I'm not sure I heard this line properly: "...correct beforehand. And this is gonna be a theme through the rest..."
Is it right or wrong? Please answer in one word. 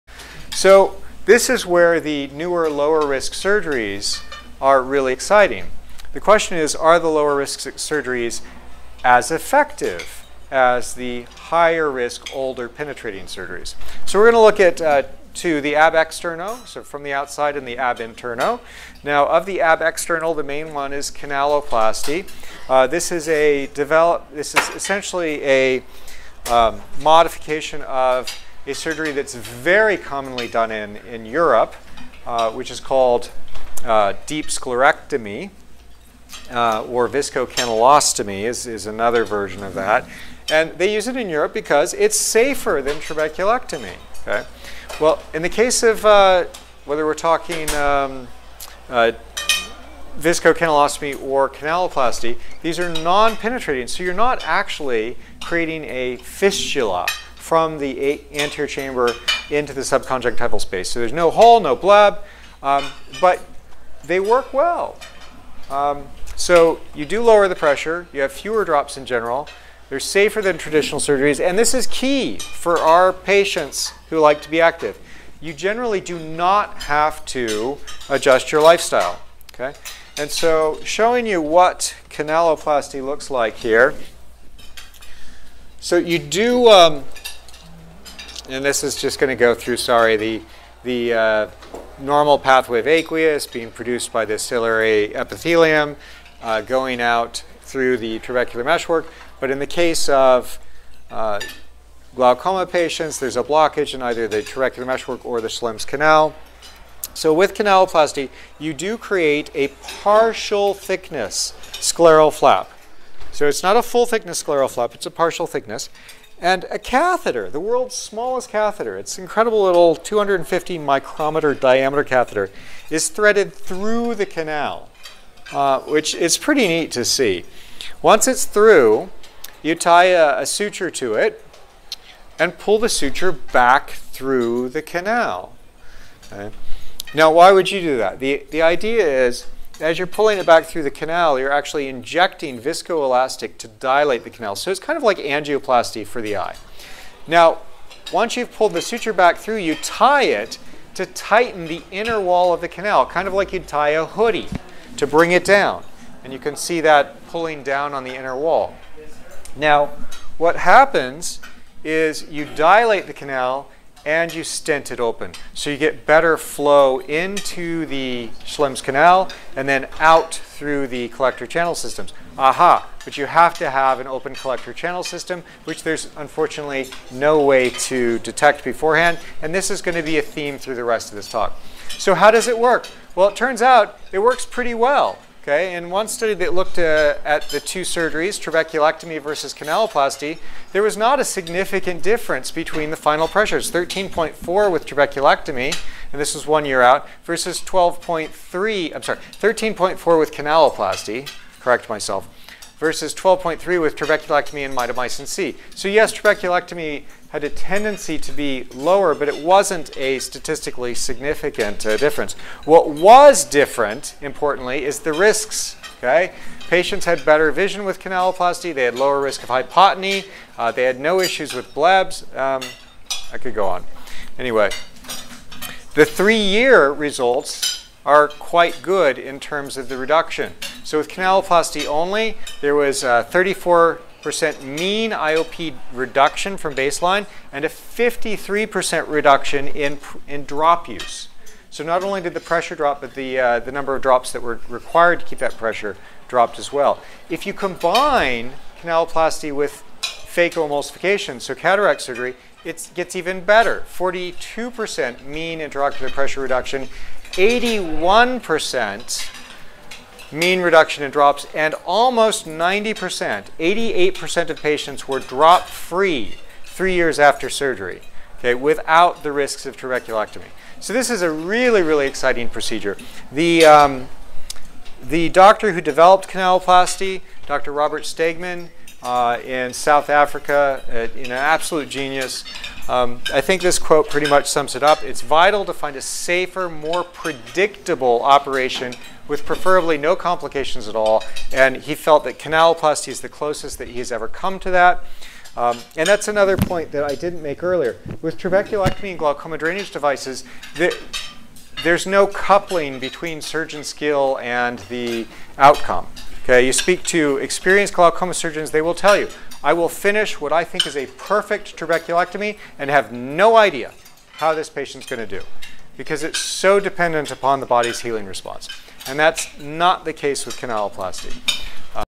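wrong.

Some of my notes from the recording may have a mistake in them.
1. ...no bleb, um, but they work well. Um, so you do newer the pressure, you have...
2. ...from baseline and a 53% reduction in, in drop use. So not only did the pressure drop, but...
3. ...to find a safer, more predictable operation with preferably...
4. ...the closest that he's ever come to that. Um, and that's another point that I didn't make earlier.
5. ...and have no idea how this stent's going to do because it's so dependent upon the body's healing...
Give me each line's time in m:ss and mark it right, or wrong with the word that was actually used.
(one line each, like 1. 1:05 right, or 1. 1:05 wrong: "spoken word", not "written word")
1. 1:01 wrong: "lower", not "newer"
2. 3:56 right
3. 4:45 right
4. 4:53 right
5. 5:12 wrong: "patient", not "stent".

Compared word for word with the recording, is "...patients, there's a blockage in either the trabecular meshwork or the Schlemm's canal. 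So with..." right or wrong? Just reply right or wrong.
right.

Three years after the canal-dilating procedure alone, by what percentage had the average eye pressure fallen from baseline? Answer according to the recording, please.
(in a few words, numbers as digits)
34%.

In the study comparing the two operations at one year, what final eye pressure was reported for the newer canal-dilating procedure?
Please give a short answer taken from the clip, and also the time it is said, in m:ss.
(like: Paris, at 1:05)
13.4, at 3:19.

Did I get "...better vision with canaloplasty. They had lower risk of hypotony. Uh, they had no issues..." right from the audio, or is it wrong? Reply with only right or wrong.
right.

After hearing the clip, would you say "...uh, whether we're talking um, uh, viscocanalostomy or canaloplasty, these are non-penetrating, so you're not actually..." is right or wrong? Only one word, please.
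right.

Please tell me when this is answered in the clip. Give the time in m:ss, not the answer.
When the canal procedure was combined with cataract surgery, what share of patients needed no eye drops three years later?
4:23.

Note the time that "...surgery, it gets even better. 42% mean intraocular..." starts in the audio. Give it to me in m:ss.
4:12.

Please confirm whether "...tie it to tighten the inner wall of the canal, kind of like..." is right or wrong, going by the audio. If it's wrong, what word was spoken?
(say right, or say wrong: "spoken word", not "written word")
right.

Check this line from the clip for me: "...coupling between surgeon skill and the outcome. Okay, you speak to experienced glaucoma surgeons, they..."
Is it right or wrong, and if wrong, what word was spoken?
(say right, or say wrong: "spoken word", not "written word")
right.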